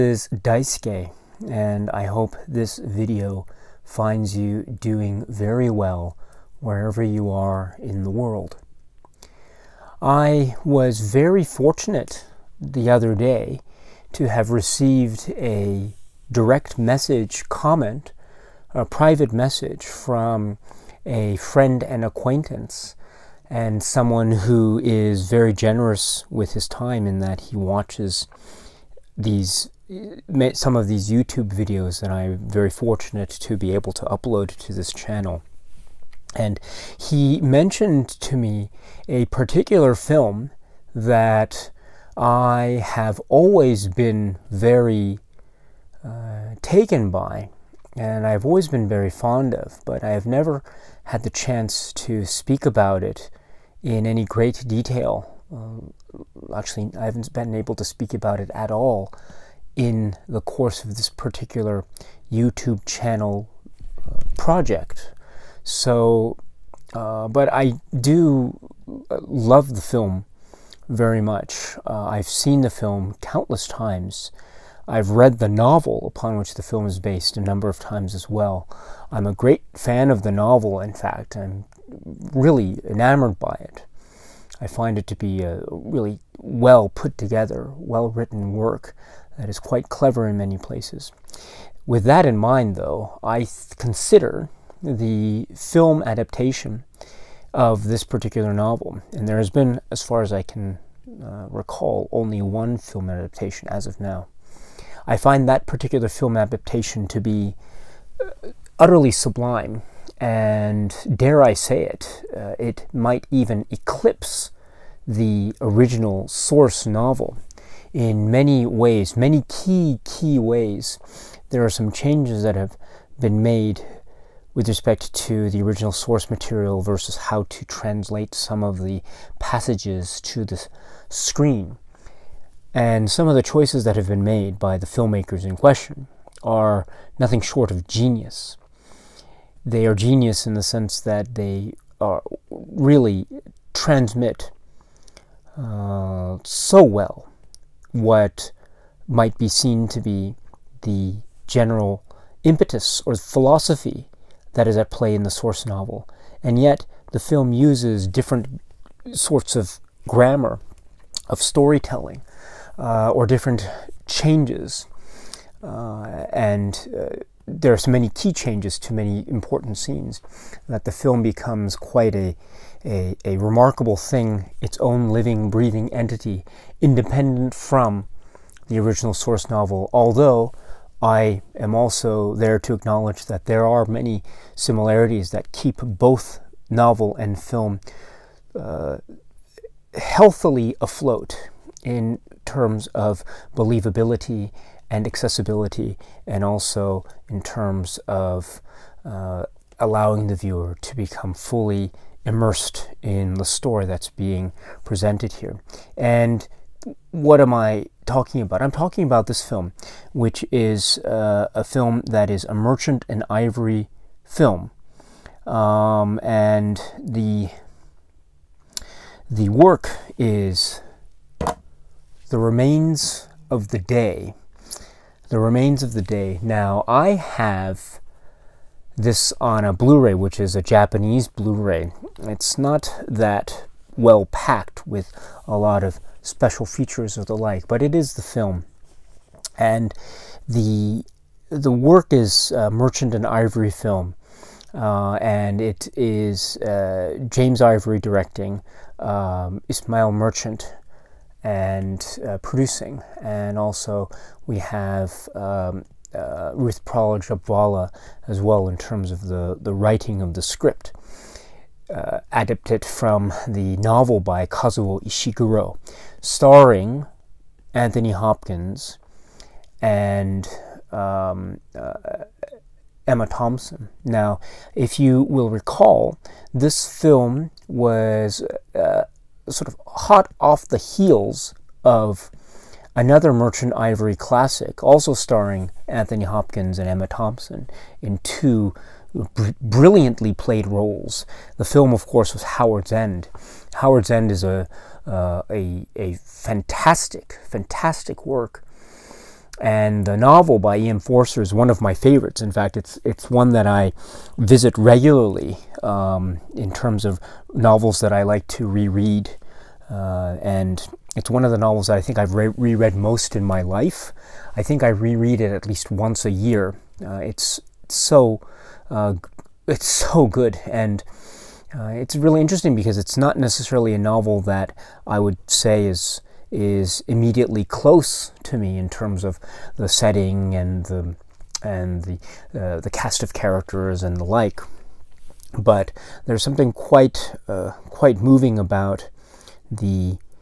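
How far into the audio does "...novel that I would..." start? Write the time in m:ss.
5:23.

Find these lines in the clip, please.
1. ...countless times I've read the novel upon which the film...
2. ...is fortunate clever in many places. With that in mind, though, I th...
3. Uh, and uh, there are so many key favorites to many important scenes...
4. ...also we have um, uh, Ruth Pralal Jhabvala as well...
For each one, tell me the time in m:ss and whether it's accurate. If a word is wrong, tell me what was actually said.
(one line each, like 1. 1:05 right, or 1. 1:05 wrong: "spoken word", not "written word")
1. 1:13 right
2. 1:29 wrong: "quite", not "fortunate"
3. 2:45 wrong: "changes", not "favorites"
4. 4:13 right.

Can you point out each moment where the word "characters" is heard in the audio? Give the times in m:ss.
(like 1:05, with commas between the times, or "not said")
5:33.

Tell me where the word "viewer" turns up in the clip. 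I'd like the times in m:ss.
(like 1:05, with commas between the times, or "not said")
3:20.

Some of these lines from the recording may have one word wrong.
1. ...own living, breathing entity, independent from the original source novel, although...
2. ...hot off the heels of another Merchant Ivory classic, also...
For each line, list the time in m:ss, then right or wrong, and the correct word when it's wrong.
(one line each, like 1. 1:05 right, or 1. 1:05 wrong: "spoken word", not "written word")
1. 2:54 right
2. 4:39 right.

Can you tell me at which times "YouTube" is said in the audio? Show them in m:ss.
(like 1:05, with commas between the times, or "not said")
0:31, 1:02.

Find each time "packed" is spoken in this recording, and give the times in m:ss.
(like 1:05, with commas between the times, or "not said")
3:54.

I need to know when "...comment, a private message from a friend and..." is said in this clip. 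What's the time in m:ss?
0:17.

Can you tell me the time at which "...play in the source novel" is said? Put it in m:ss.
2:34.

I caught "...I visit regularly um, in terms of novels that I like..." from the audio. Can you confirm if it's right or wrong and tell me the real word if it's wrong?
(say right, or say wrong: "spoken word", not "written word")
right.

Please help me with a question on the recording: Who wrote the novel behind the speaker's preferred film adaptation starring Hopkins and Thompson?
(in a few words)
Kazuo Ishiguro.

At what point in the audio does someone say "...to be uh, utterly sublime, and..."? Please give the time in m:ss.
1:47.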